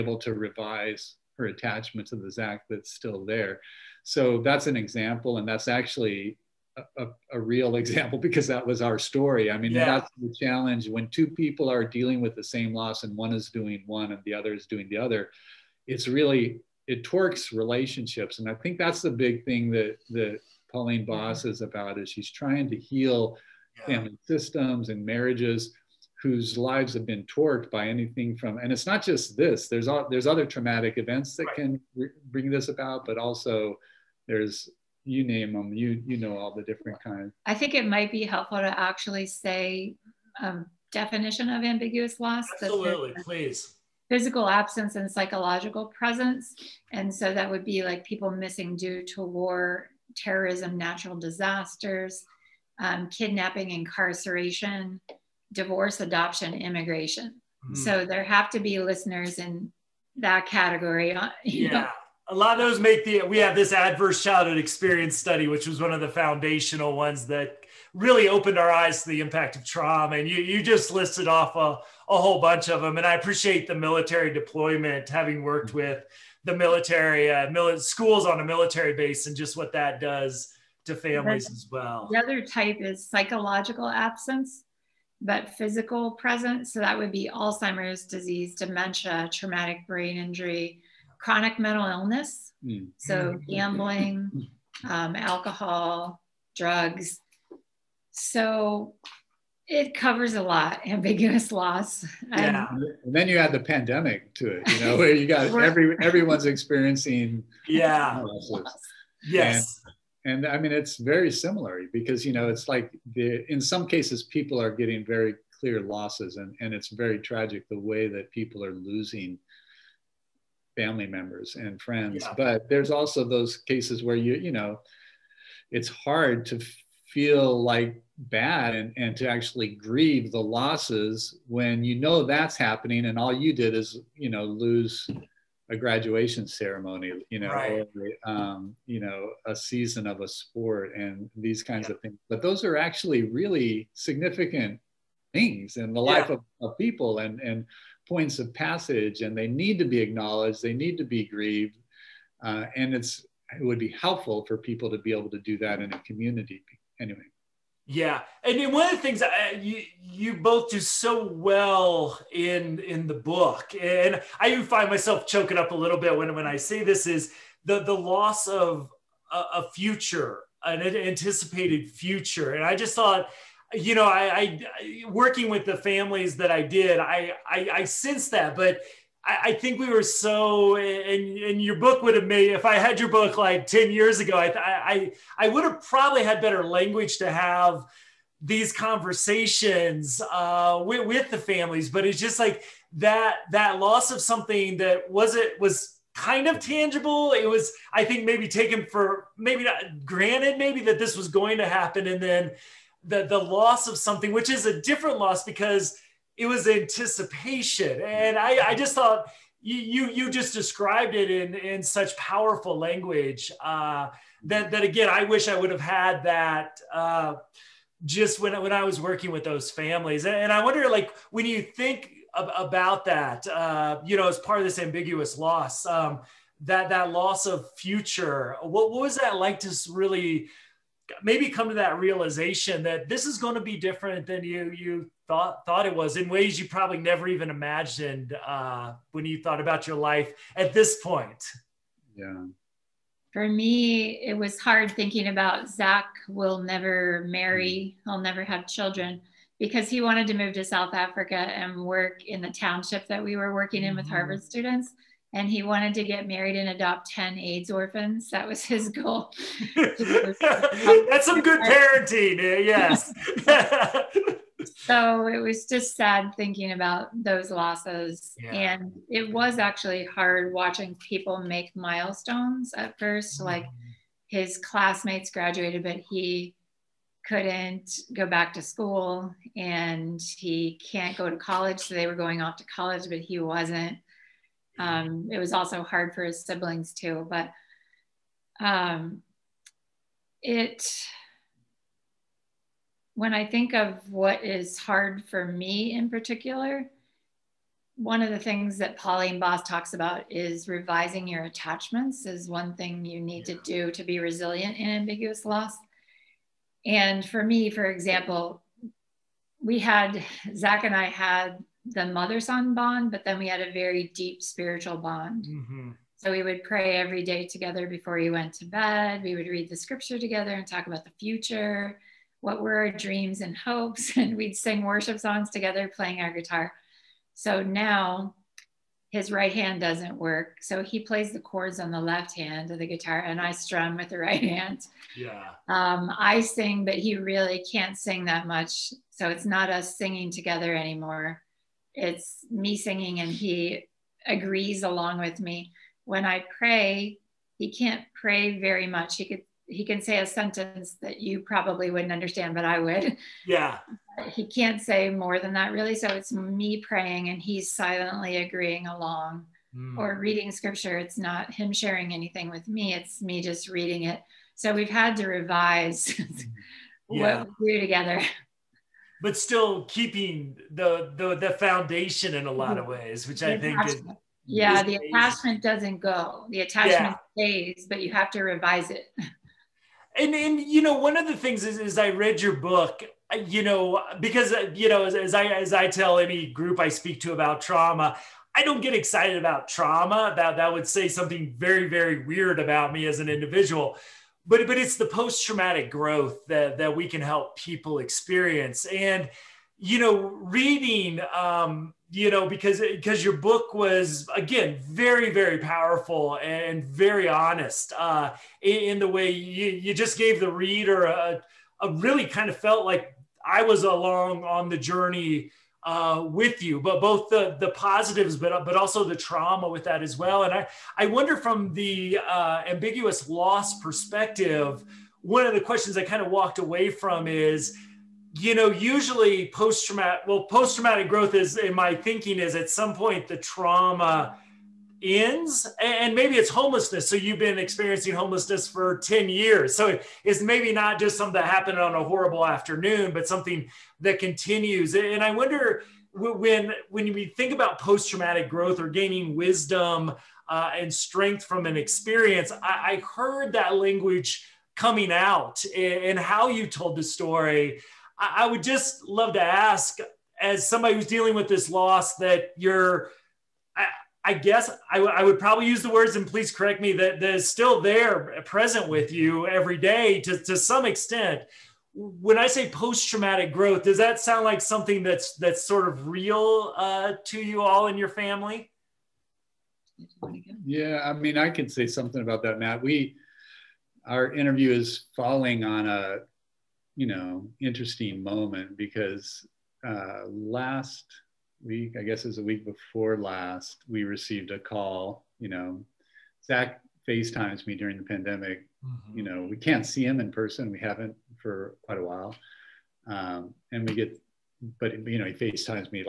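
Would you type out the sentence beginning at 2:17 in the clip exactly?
or, um, you know, a season of a sport and these kinds yeah.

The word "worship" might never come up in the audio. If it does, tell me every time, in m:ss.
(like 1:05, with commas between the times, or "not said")
5:24.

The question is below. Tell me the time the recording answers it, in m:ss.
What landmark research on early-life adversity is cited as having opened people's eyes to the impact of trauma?
1:03.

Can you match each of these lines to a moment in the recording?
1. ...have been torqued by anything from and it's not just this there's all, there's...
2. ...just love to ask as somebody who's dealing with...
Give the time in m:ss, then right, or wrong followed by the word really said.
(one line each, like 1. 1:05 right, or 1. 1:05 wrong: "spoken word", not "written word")
1. 0:26 right
2. 7:38 right.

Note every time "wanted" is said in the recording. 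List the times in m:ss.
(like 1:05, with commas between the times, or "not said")
4:10, 4:15.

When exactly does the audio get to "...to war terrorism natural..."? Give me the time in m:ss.
0:49.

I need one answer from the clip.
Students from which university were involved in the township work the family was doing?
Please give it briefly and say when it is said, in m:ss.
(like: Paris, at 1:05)
Harvard, at 4:14.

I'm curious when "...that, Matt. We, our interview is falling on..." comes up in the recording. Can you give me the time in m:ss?
8:02.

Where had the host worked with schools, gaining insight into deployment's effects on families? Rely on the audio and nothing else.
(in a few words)
A military base.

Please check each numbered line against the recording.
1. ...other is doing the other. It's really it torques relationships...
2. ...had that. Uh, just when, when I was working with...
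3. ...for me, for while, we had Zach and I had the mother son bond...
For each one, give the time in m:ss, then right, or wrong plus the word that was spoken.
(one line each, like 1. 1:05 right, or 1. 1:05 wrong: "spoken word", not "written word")
1. 0:14 right
2. 3:35 right
3. 5:07 wrong: "example", not "while".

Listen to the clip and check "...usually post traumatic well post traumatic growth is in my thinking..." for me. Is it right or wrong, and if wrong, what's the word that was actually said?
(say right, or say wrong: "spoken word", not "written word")
right.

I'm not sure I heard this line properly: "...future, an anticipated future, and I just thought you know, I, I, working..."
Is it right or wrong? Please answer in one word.
right.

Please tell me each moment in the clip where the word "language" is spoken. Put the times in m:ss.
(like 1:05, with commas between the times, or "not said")
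3:06, 3:32, 7:33.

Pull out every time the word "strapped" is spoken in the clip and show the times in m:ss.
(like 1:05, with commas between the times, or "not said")
not said.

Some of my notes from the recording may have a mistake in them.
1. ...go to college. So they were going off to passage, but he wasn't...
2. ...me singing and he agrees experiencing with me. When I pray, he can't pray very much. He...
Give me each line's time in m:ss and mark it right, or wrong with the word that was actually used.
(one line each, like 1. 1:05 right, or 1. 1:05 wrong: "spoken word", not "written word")
1. 4:41 wrong: "college", not "passage"
2. 5:42 wrong: "along", not "experiencing".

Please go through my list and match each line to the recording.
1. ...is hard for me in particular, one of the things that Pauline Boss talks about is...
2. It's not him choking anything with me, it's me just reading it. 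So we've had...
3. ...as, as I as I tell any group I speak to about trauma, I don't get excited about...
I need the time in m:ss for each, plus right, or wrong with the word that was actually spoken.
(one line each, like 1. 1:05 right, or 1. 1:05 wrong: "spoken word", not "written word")
1. 4:54 right
2. 6:00 wrong: "sharing", not "choking"
3. 6:25 right.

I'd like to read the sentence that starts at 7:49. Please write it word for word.
you every day to, to some extent.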